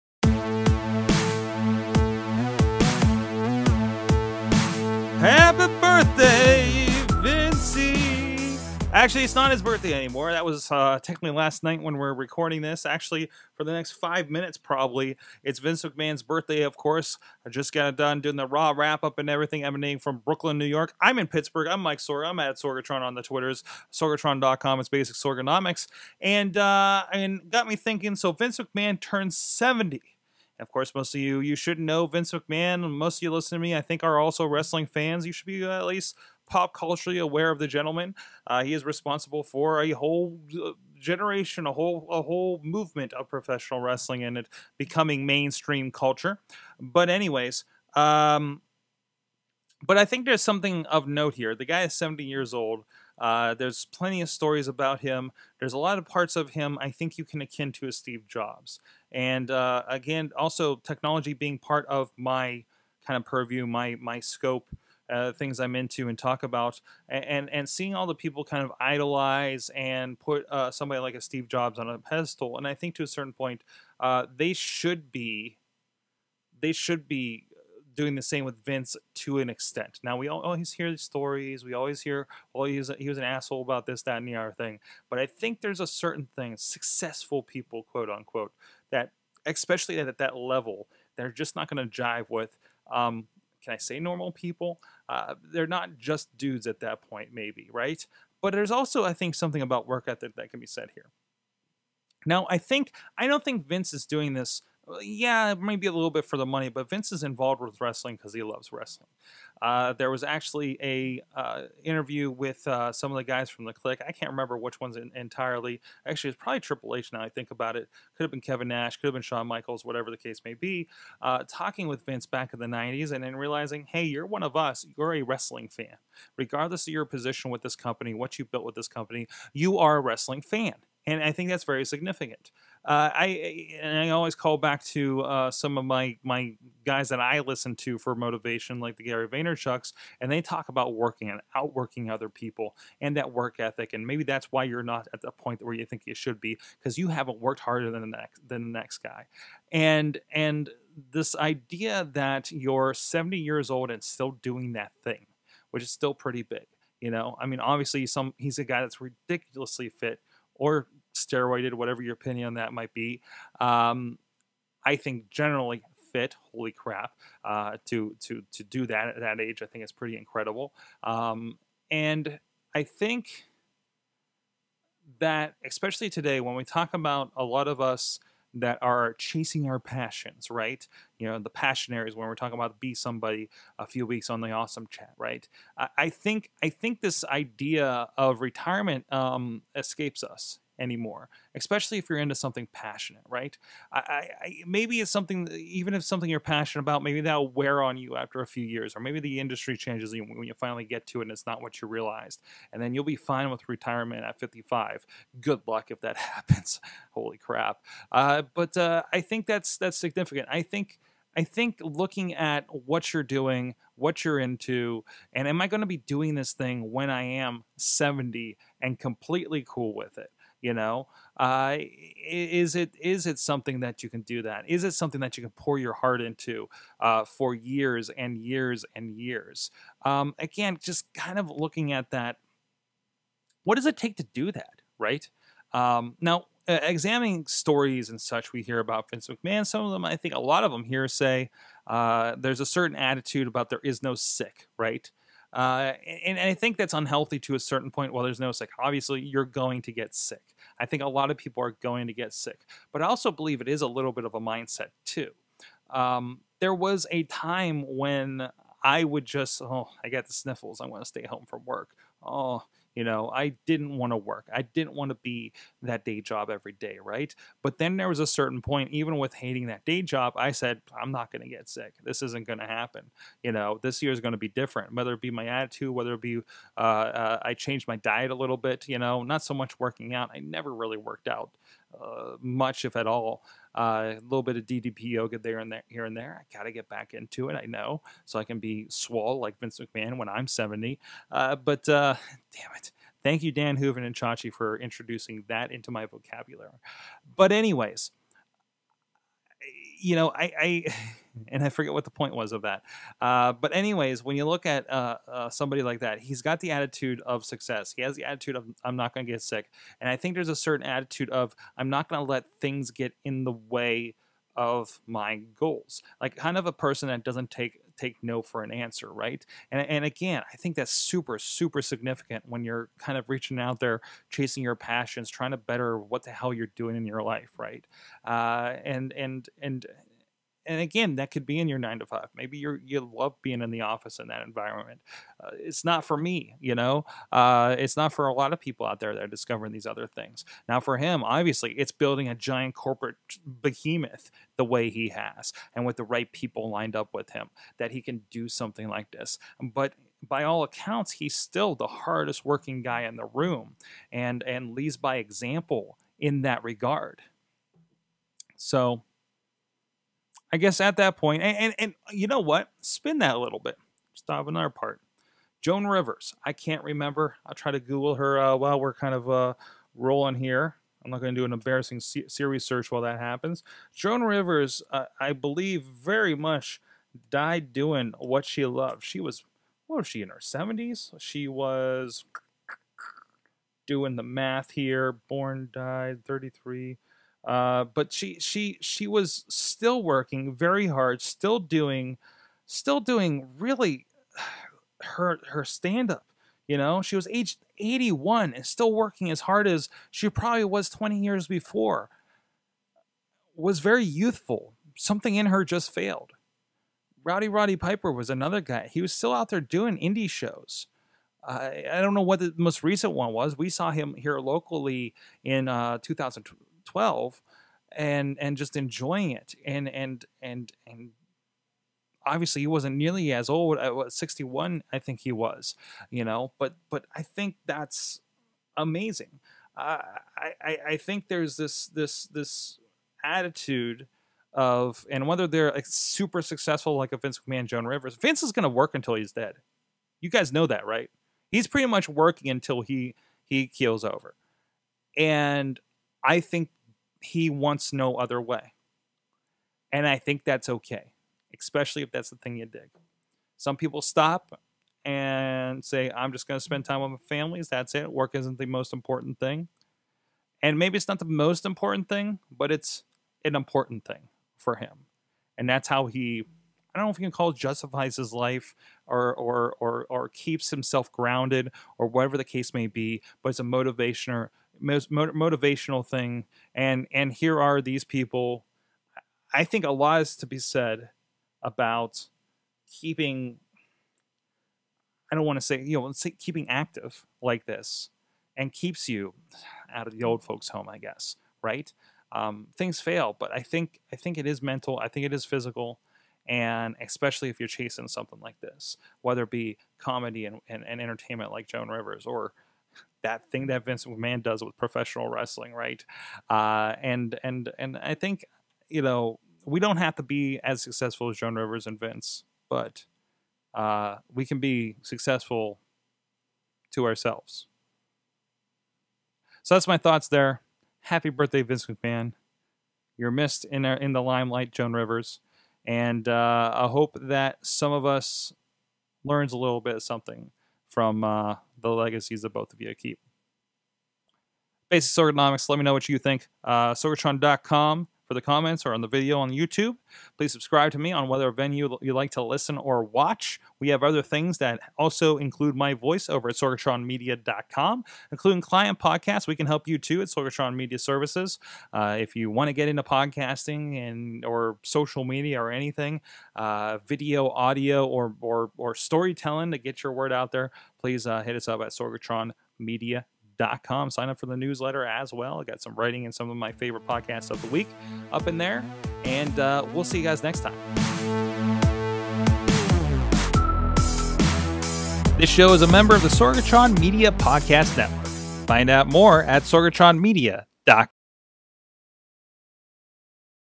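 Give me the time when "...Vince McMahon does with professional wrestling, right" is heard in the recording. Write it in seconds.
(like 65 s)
503 s.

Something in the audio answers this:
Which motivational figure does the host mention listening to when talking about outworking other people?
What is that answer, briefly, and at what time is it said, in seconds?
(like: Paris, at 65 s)
Gary Vaynerchuk, at 139 s.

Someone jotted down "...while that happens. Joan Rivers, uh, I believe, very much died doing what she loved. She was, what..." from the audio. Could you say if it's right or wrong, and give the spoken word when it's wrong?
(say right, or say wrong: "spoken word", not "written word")
right.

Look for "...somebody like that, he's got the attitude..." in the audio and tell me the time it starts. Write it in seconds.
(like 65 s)
305 s.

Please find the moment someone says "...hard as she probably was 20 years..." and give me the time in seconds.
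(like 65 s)
399 s.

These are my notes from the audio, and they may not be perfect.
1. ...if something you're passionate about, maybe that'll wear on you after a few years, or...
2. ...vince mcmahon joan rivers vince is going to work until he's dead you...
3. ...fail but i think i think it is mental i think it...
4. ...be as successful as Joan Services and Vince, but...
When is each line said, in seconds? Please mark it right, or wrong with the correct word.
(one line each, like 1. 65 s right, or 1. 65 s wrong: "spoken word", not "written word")
1. 195 s right
2. 437 s right
3. 492 s right
4. 510 s wrong: "Rivers", not "Services".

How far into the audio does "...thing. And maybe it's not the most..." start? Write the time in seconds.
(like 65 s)
459 s.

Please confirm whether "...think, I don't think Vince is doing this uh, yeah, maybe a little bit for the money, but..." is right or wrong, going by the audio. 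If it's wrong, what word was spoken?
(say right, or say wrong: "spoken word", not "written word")
right.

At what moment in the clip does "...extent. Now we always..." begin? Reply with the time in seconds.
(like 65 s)
79 s.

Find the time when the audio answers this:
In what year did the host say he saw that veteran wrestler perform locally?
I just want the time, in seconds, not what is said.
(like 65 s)
416 s.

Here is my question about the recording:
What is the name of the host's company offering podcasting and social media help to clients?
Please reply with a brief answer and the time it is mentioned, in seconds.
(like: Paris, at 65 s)
Sorgatron Media Services, at 550 s.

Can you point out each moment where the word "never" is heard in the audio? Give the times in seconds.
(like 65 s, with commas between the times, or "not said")
280 s.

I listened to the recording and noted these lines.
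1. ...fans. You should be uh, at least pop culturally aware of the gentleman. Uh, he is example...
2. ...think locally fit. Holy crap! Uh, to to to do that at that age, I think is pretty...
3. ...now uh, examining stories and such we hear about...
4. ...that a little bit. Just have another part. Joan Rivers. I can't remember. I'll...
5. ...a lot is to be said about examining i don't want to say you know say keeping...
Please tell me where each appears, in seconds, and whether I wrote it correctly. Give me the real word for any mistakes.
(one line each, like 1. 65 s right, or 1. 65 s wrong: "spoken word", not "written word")
1. 34 s wrong: "responsible", not "example"
2. 164 s wrong: "generally", not "locally"
3. 236 s right
4. 363 s right
5. 479 s wrong: "keeping", not "examining".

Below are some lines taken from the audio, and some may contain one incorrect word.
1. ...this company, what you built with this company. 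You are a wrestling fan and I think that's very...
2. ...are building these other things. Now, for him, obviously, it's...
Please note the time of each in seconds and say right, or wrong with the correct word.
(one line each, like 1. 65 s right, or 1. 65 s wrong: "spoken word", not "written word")
1. 127 s right
2. 339 s wrong: "discovering", not "building".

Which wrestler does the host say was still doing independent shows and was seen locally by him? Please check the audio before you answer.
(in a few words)
Rowdy Roddy Piper.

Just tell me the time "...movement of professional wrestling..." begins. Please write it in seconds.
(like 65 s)
42 s.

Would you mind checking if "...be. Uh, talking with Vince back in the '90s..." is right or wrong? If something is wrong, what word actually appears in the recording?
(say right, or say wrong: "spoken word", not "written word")
right.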